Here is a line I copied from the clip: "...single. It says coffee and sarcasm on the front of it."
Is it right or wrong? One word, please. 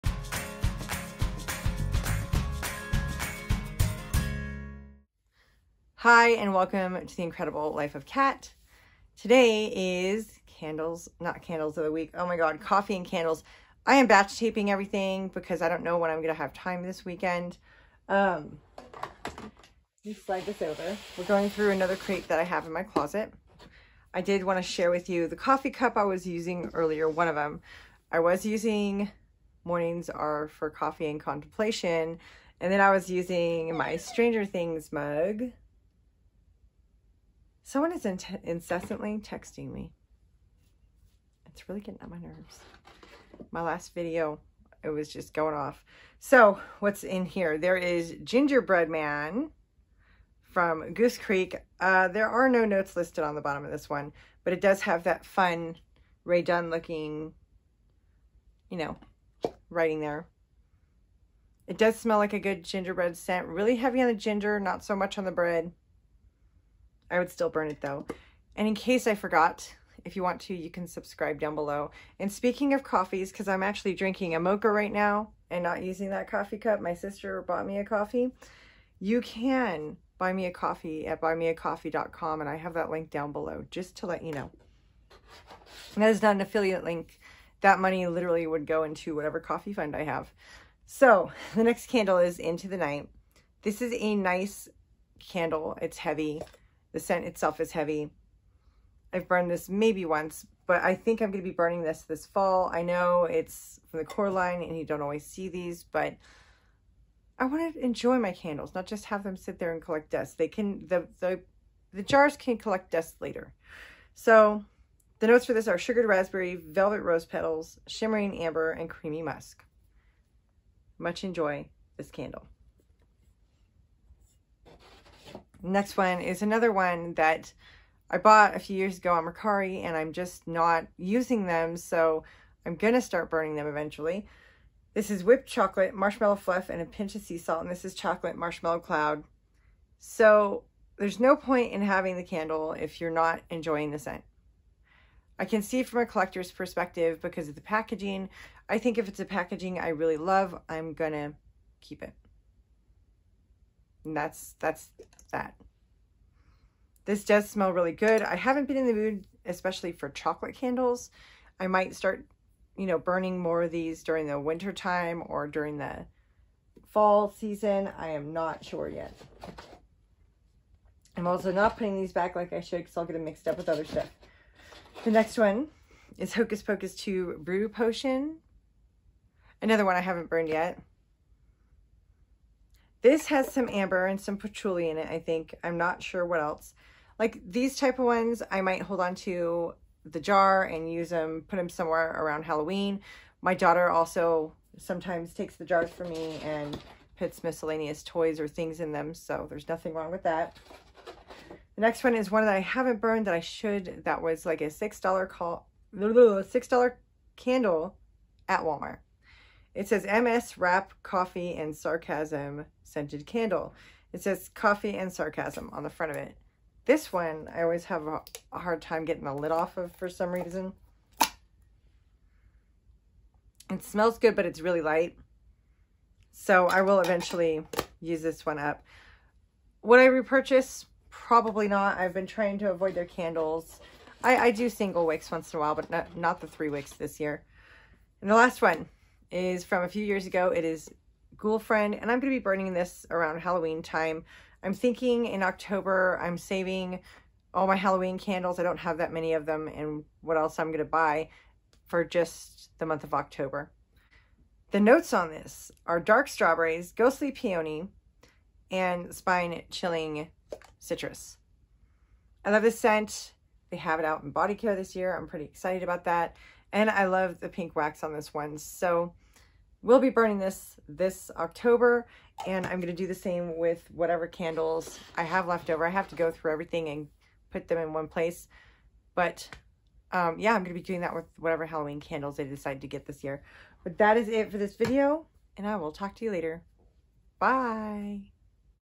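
wrong.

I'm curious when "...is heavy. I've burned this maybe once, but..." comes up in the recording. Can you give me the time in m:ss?
1:37.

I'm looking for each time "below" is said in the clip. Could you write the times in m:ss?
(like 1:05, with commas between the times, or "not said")
1:11, 1:23.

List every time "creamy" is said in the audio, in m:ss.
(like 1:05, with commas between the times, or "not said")
1:58.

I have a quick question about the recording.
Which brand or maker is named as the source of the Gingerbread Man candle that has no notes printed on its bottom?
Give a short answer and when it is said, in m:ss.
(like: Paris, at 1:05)
Goose Creek, at 0:50.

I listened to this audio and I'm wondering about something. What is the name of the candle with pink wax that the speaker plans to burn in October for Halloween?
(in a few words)
Ghoul Friend.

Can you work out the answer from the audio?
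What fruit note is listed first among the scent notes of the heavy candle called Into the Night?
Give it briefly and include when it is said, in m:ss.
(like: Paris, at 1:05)
sugared raspberry, at 1:55.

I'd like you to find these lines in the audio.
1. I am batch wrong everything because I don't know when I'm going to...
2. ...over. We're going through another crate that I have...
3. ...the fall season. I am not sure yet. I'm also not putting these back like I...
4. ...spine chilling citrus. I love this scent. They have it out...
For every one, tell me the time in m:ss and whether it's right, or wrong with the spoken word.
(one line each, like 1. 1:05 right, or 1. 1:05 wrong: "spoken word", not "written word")
1. 0:13 wrong: "taping", not "wrong"
2. 0:20 right
3. 2:45 right
4. 4:19 right.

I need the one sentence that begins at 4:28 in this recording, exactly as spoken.
So will be burning this this October and I'm going to do the same with whatever candles I have left over.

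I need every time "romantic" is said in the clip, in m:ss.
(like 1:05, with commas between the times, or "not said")
not said.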